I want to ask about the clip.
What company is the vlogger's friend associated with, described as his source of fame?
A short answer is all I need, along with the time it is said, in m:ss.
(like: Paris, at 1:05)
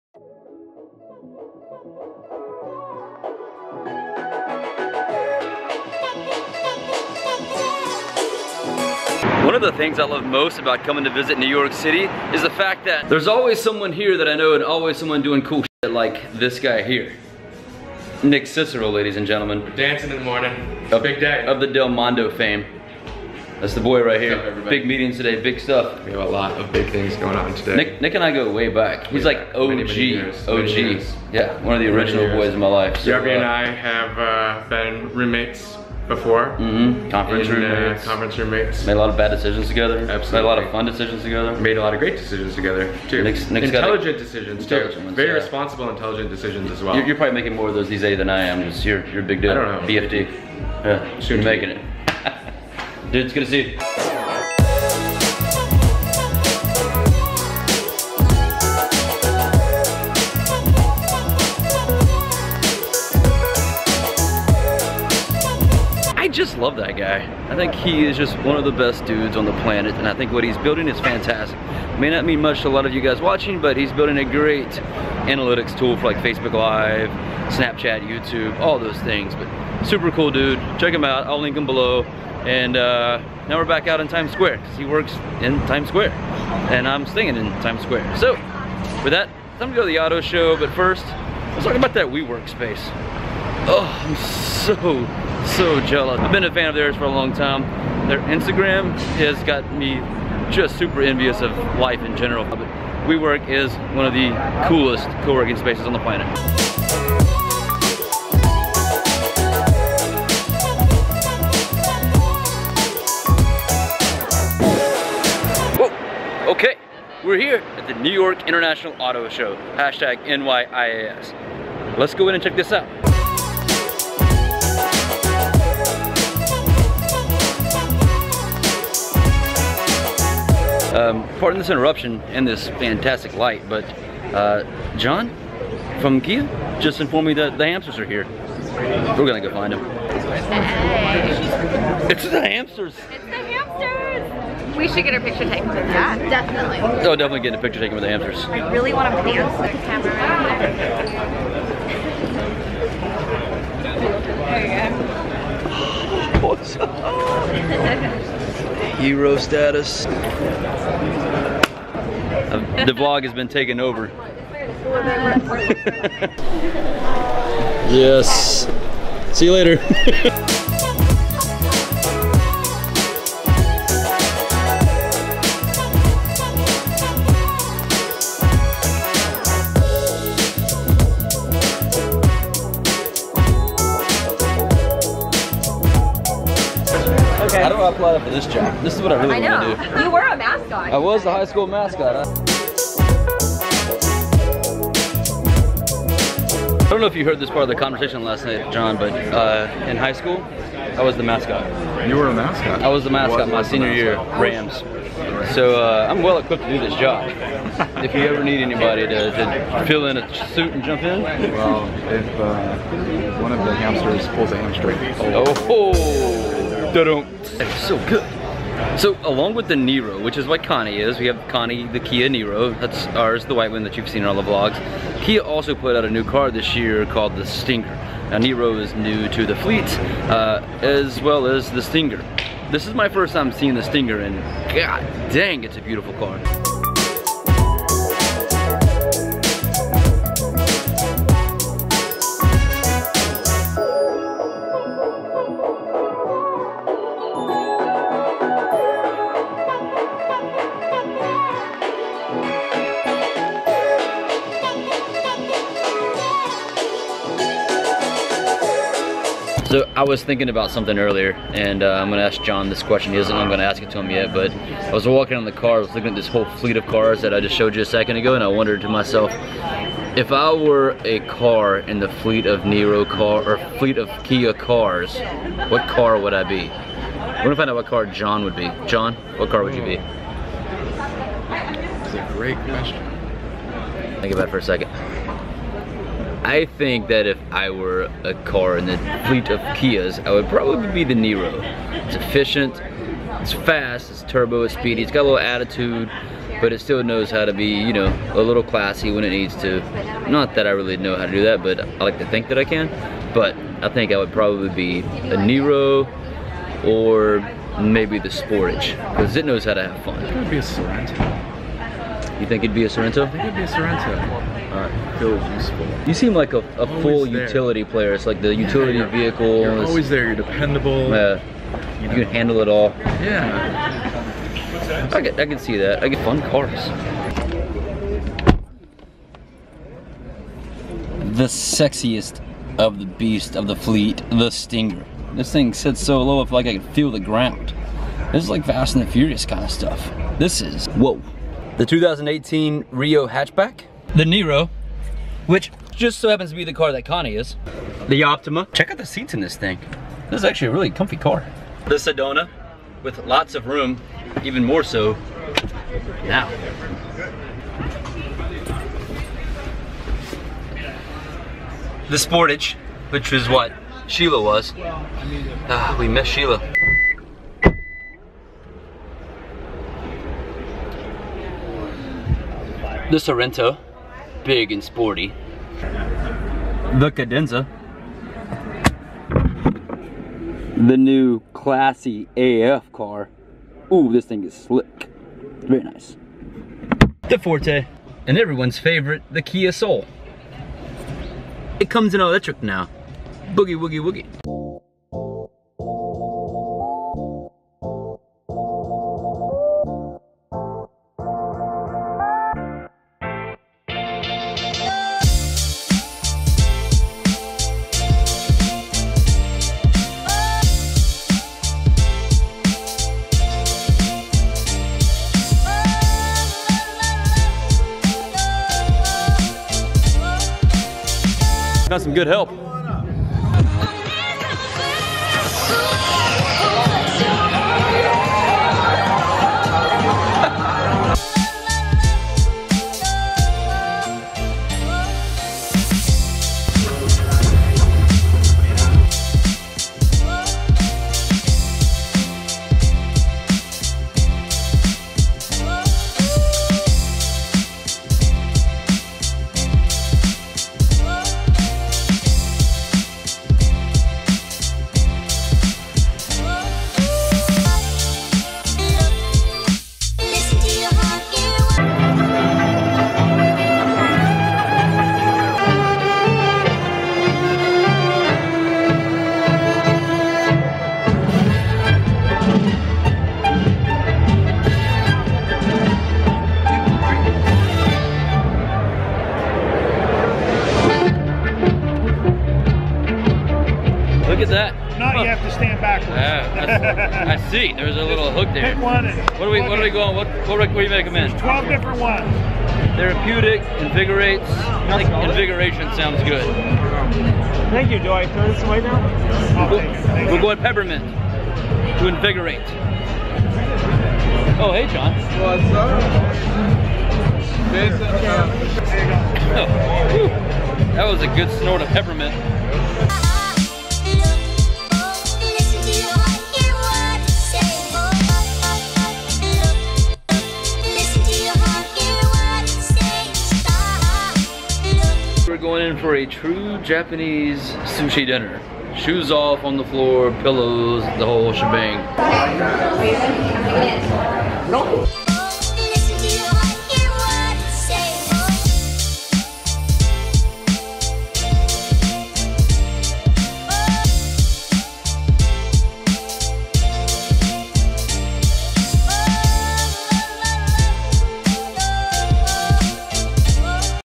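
Delmondo, at 0:21.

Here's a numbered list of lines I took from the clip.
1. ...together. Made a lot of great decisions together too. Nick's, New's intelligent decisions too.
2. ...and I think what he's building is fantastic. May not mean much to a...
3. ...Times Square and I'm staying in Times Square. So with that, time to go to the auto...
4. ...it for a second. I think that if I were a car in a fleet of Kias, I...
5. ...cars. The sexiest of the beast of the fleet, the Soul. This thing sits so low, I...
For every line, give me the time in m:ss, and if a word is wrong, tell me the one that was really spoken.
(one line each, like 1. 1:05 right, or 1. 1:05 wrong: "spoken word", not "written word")
1. 0:41 wrong: "Nick", not "New"
2. 1:09 right
3. 1:25 right
4. 4:44 right
5. 5:26 wrong: "Stinger", not "Soul".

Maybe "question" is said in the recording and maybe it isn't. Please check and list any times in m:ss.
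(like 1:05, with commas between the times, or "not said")
4:22, 4:42.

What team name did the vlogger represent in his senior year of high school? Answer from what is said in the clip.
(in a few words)
Rams.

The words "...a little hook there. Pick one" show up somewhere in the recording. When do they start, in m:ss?
8:07.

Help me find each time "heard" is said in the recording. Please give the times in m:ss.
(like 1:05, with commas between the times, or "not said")
3:17.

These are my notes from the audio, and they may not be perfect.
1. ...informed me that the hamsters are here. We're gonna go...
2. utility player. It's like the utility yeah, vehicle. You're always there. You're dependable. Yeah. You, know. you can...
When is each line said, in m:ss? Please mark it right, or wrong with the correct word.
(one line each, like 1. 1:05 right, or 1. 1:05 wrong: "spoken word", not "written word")
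1. 2:16 right
2. 5:17 right.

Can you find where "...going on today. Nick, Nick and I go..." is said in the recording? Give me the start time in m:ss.
0:27.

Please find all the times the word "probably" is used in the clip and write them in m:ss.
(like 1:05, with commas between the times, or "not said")
0:47, 4:50, 5:04.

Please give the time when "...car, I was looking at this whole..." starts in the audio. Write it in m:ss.
4:25.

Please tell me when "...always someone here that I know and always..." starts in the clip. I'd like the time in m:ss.
0:13.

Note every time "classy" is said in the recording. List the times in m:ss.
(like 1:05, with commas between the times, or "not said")
4:58, 6:21.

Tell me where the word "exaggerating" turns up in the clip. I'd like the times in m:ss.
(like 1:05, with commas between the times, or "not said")
not said.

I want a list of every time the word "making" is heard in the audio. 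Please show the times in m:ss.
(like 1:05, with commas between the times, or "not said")
0:47, 0:51.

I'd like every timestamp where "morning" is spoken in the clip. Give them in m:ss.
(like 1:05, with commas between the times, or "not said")
0:20.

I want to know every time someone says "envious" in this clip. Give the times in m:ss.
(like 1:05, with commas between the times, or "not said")
1:41.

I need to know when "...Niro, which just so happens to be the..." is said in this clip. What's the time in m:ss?
5:44.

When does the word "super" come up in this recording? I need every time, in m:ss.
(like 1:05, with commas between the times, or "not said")
1:19, 1:40.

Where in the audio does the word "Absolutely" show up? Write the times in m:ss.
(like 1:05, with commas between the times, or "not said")
0:40.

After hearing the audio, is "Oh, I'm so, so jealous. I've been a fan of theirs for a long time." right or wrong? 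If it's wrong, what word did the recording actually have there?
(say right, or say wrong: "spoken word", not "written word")
right.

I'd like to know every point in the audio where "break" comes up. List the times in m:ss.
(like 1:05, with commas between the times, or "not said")
not said.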